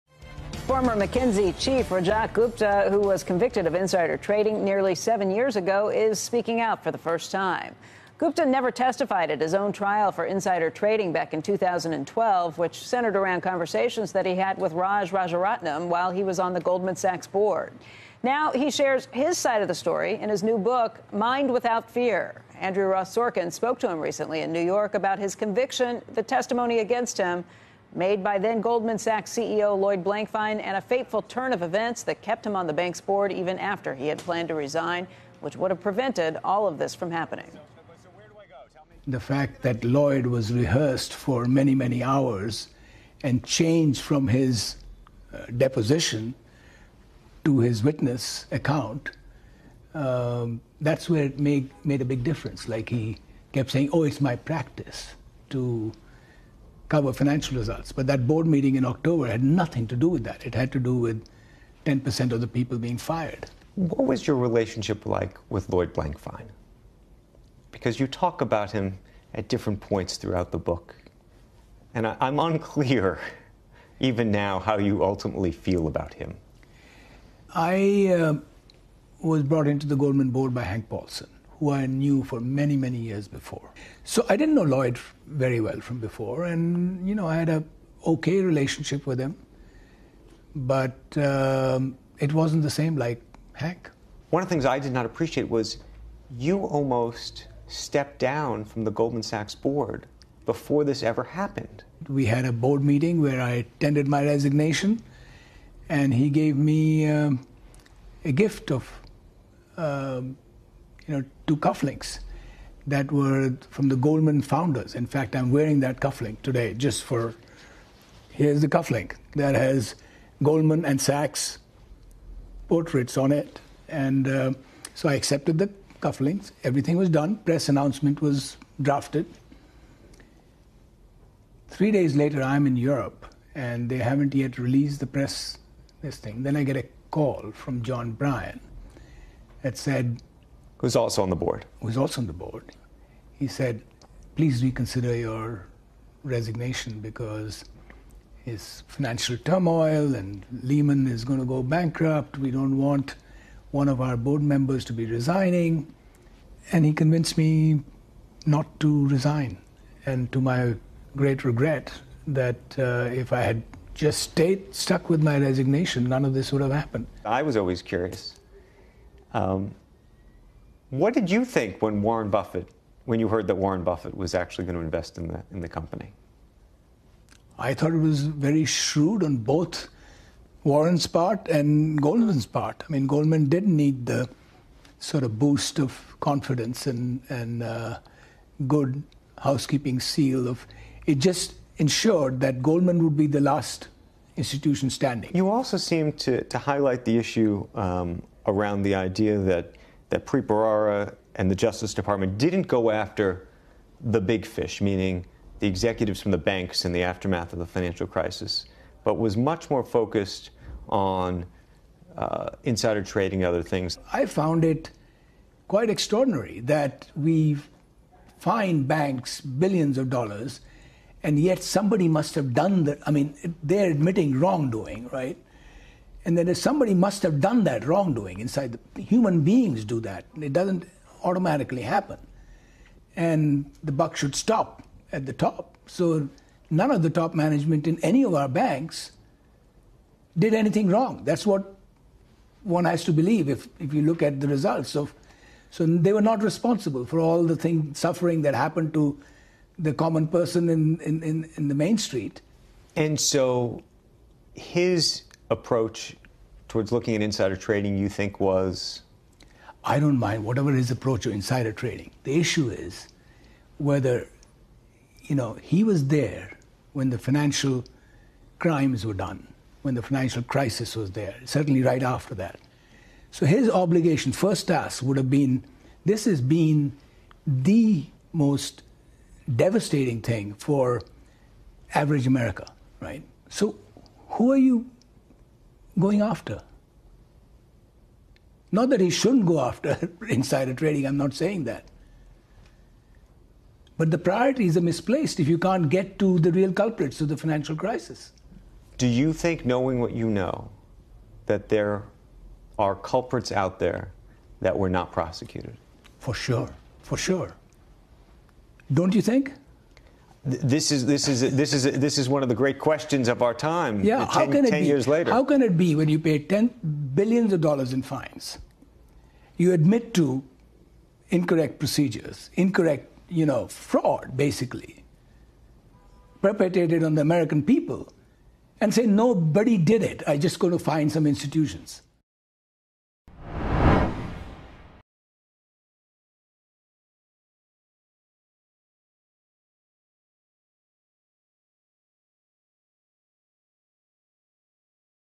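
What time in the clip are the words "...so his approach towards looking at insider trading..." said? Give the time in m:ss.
4:13.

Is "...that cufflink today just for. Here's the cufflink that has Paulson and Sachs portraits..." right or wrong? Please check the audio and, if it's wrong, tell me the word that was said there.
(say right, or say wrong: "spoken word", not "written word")
wrong: "Goldman", not "Paulson".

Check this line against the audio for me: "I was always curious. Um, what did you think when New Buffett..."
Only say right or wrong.
wrong.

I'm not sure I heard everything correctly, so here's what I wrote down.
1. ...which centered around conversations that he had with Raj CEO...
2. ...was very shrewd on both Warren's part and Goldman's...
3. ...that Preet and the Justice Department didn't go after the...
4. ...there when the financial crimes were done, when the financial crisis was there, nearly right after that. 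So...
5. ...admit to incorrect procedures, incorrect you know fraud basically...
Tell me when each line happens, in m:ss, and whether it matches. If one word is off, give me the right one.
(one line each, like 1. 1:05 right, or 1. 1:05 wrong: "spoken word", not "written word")
1. 0:12 wrong: "Rajaratnam", not "CEO"
2. 2:57 right
3. 3:20 right
4. 4:26 wrong: "certainly", not "nearly"
5. 5:19 right.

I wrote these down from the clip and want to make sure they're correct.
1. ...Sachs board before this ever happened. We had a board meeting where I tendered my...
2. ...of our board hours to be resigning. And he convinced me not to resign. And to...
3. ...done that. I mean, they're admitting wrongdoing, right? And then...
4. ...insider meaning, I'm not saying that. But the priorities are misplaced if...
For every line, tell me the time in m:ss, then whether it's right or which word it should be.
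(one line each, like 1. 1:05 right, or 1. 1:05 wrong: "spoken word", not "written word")
1. 1:39 right
2. 2:33 wrong: "members", not "hours"
3. 3:42 right
4. 4:50 wrong: "trading", not "meaning".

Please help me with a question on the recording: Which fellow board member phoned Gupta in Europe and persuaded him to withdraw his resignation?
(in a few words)
John Bryan.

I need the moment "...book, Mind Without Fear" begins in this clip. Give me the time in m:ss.
0:20.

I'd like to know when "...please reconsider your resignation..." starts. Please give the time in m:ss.
2:24.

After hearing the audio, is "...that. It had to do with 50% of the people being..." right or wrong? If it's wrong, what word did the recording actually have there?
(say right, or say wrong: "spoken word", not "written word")
wrong: "10", not "50".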